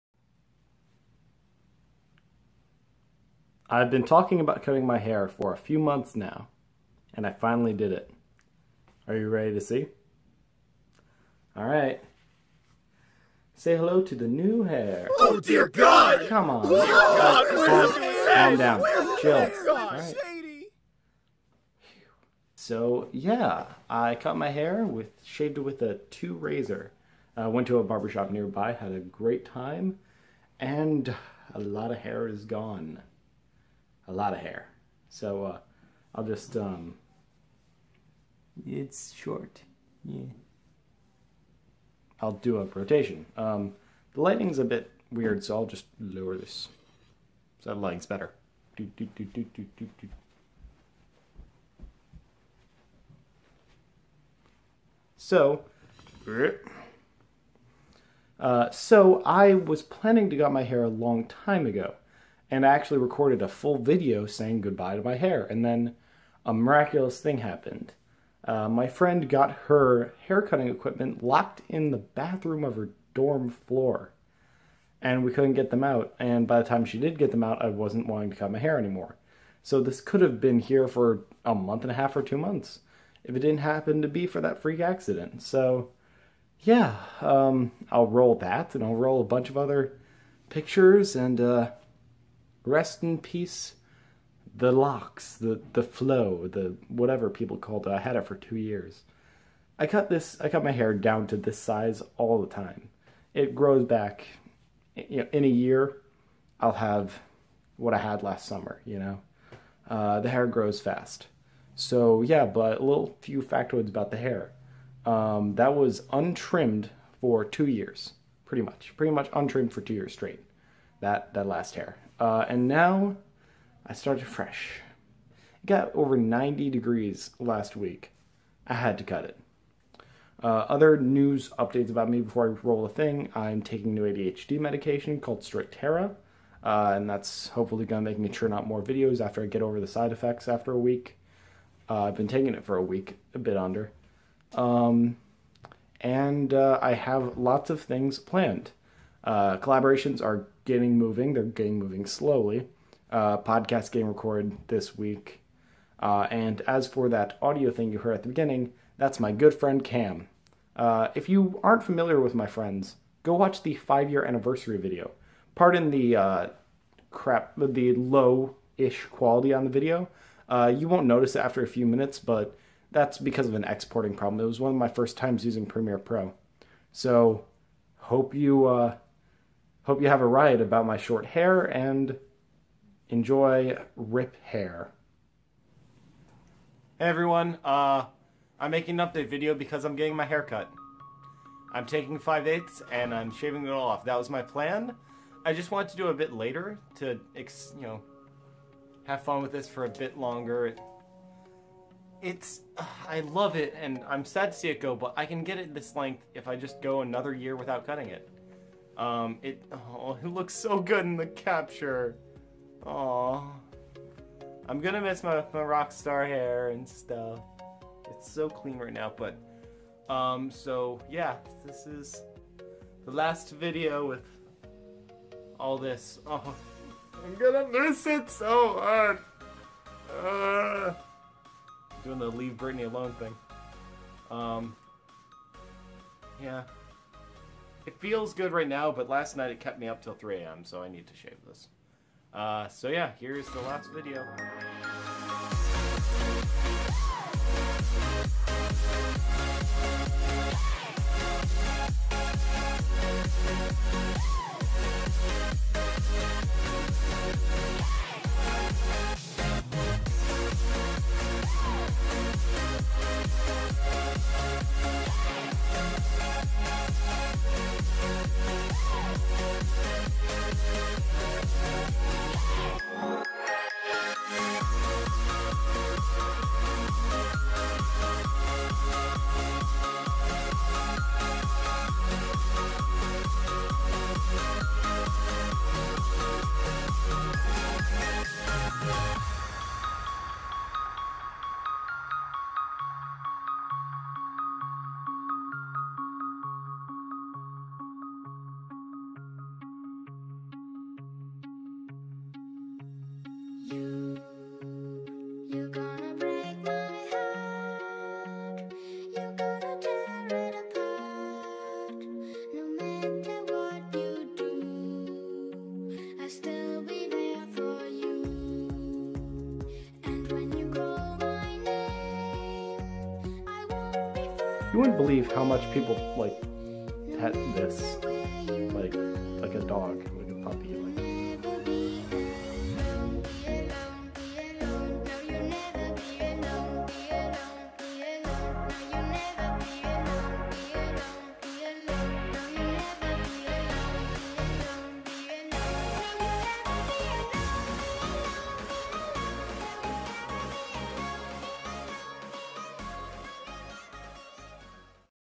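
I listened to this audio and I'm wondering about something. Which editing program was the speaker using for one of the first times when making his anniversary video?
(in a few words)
Premiere Pro.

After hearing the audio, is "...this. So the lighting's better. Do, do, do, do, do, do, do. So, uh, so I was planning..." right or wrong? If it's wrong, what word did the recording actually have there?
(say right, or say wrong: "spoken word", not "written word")
right.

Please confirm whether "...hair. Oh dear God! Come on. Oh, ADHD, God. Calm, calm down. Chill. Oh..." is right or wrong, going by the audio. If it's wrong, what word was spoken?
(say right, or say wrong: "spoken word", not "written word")
wrong: "God", not "ADHD".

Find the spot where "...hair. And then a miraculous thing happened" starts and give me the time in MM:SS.
01:05.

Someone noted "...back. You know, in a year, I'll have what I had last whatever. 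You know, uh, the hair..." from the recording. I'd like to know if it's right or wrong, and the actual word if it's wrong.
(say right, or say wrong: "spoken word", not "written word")
wrong: "summer", not "whatever".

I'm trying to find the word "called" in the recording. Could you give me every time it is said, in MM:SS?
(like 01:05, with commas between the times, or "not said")
01:37, 02:15.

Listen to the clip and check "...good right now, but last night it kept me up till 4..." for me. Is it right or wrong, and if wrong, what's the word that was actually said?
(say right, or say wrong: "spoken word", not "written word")
wrong: "3", not "4".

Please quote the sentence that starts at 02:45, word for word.
Pardon the uh, crap, the low ish quality on the video.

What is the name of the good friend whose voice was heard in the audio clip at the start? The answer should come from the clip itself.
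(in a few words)
Cam.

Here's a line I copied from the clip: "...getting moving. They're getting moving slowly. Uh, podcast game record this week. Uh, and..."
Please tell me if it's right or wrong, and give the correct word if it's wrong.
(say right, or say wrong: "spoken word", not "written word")
right.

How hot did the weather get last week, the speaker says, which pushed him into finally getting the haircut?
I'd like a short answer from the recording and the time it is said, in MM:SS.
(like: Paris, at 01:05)
Over 90 degrees, at 02:05.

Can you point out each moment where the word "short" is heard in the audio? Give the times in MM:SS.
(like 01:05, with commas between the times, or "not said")
00:39, 03:00.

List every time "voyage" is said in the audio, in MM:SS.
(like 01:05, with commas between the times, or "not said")
not said.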